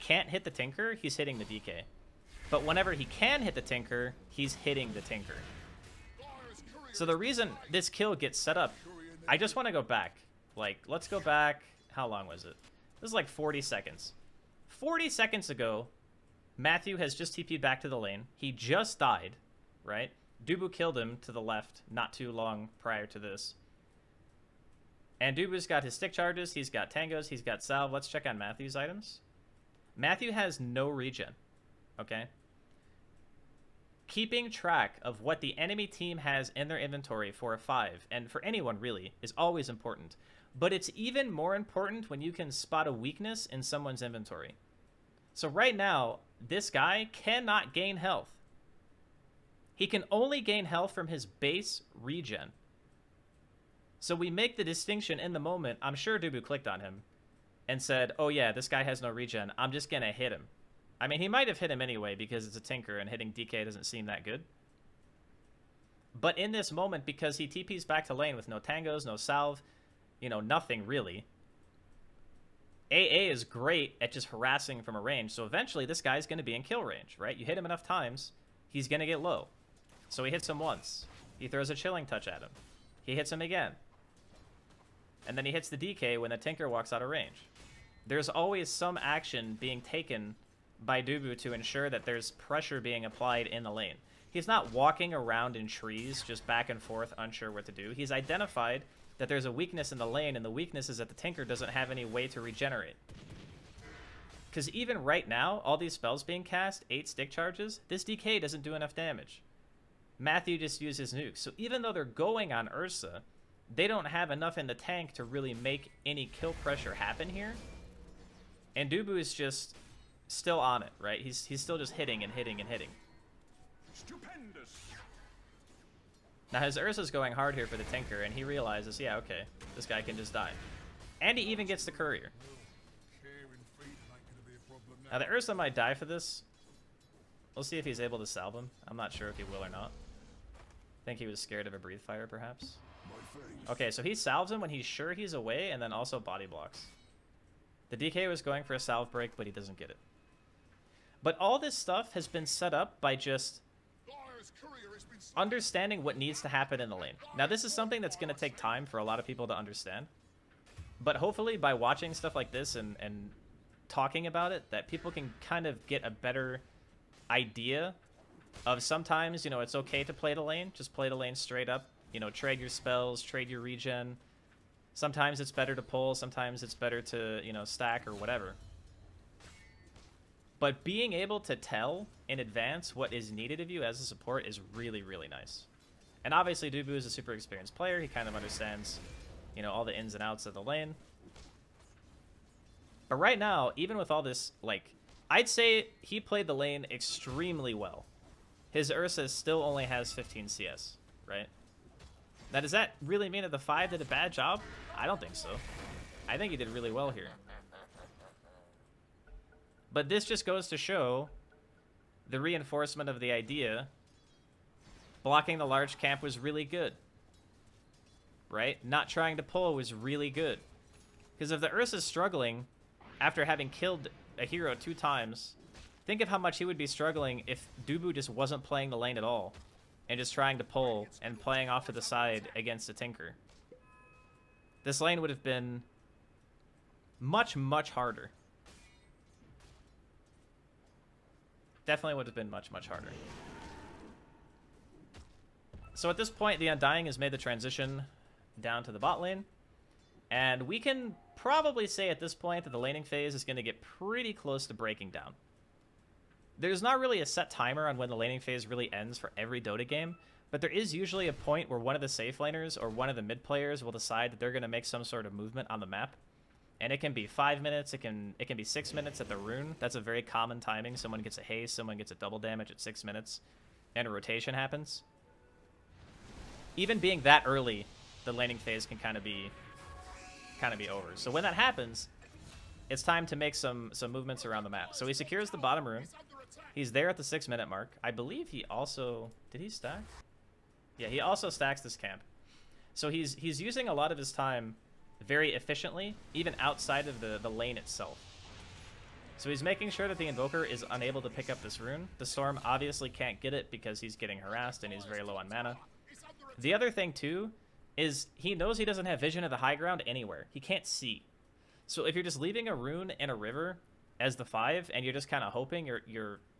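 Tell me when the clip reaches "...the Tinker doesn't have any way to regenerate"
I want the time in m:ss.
1:41.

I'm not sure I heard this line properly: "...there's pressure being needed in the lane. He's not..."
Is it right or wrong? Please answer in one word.
wrong.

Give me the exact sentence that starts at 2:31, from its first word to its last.
But all this stuff has been set up by just understanding what needs to happen in the lane.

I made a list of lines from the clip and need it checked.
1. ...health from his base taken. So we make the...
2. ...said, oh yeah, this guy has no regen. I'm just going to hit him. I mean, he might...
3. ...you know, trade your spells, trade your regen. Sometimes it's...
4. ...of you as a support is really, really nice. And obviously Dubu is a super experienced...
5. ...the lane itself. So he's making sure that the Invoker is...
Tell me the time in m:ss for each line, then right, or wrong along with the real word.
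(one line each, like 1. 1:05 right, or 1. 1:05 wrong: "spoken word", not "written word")
1. 0:50 wrong: "regen", not "taken"
2. 0:57 right
3. 2:52 right
4. 3:03 right
5. 4:57 right.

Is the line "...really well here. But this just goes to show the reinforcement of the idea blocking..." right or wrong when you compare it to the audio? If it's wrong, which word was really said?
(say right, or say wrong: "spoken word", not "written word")
right.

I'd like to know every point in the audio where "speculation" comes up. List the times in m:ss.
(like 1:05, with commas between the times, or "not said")
not said.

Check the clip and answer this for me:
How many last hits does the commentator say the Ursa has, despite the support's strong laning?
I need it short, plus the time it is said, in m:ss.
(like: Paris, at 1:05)
15, at 3:20.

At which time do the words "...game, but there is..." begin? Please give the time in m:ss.
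4:19.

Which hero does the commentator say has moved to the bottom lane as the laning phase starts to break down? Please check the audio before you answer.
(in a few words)
Undying.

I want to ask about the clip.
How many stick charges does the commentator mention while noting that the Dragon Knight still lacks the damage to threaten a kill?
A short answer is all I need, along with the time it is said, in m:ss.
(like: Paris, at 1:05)
8, at 1:46.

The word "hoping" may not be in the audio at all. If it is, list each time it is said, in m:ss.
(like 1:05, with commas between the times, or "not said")
5:15.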